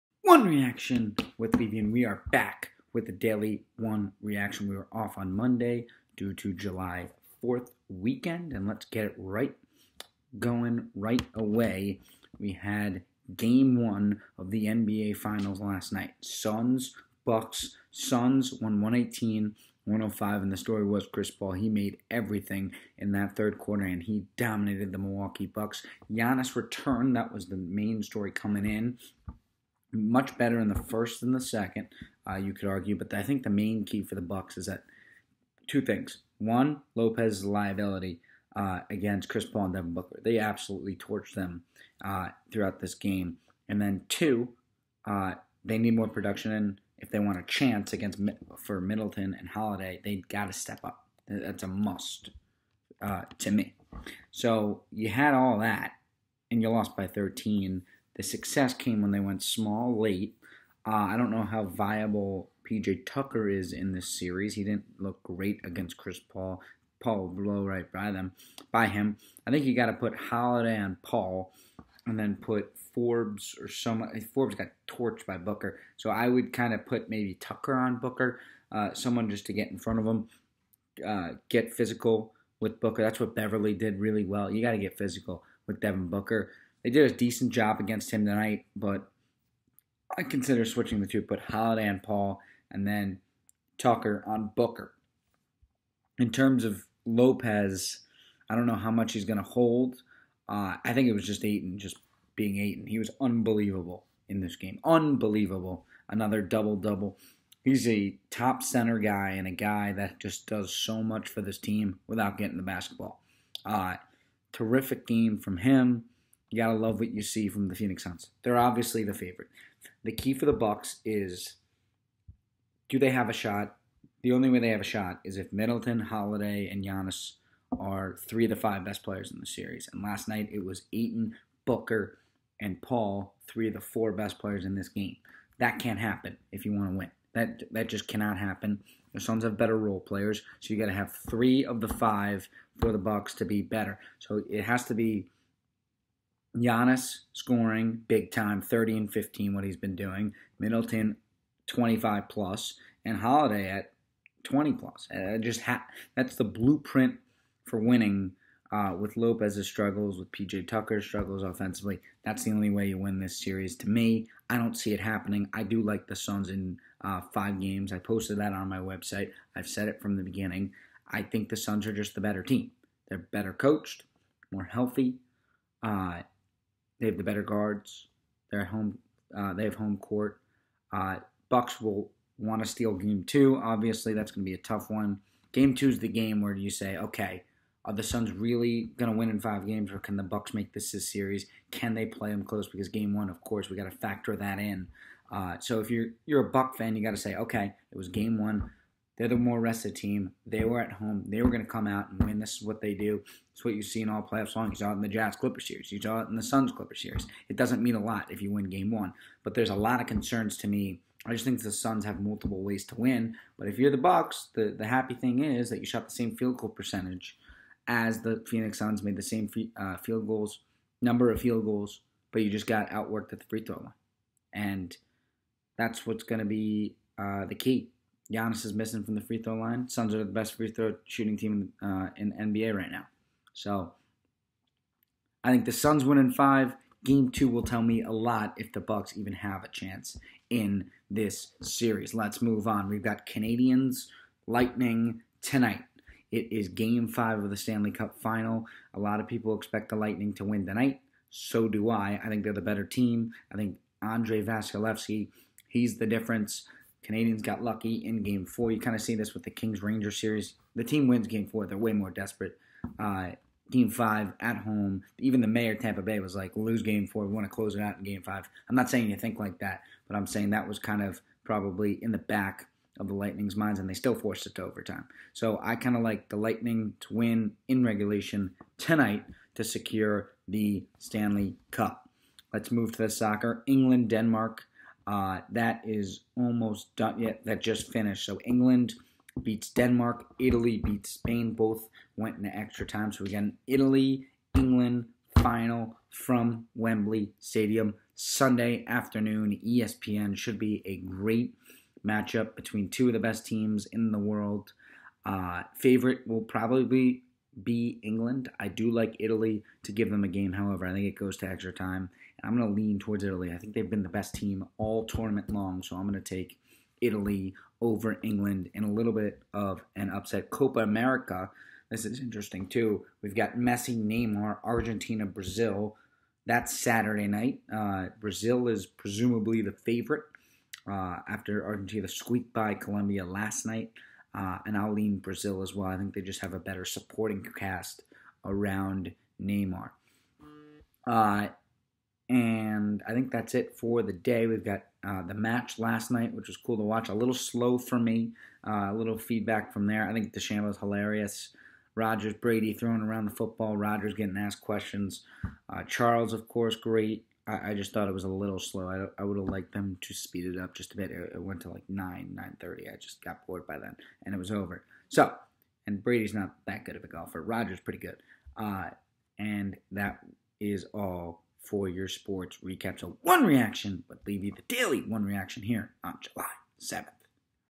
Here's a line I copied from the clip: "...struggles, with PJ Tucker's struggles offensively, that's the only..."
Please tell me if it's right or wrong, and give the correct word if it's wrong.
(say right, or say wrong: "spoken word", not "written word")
right.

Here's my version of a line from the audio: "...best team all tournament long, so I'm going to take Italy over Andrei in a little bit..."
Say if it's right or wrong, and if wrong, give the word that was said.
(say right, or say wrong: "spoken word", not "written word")
wrong: "England", not "Andrei".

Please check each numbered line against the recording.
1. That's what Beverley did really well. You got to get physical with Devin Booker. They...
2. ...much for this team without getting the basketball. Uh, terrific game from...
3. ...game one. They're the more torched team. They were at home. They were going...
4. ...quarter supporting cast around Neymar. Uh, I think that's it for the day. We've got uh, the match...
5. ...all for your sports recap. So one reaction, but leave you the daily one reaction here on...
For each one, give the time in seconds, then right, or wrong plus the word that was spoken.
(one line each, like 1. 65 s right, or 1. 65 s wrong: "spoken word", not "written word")
1. 83 s right
2. 111 s right
3. 198 s wrong: "rested", not "torched"
4. 336 s wrong: "better", not "quarter"
5. 370 s right.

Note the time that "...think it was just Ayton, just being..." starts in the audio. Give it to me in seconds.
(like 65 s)
100 s.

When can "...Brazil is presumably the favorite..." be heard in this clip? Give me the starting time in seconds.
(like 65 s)
328 s.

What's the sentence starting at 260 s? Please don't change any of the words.
The team wins game four, they're way more desperate.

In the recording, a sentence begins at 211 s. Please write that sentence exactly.
I just think the Suns have multiple ways to win.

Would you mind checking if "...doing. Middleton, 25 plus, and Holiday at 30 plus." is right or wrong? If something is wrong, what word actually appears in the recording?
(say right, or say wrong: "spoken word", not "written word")
wrong: "20", not "30".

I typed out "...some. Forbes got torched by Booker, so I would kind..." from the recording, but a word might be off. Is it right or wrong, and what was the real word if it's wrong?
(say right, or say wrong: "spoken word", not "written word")
right.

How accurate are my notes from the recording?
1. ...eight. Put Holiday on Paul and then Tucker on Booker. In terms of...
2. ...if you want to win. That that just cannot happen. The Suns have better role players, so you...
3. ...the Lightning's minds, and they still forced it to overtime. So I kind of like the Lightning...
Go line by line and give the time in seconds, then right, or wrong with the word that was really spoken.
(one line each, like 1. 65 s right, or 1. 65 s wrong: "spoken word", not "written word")
1. 91 s wrong: "two", not "eight"
2. 136 s right
3. 273 s right.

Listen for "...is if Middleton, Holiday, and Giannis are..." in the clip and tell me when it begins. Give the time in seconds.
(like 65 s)
125 s.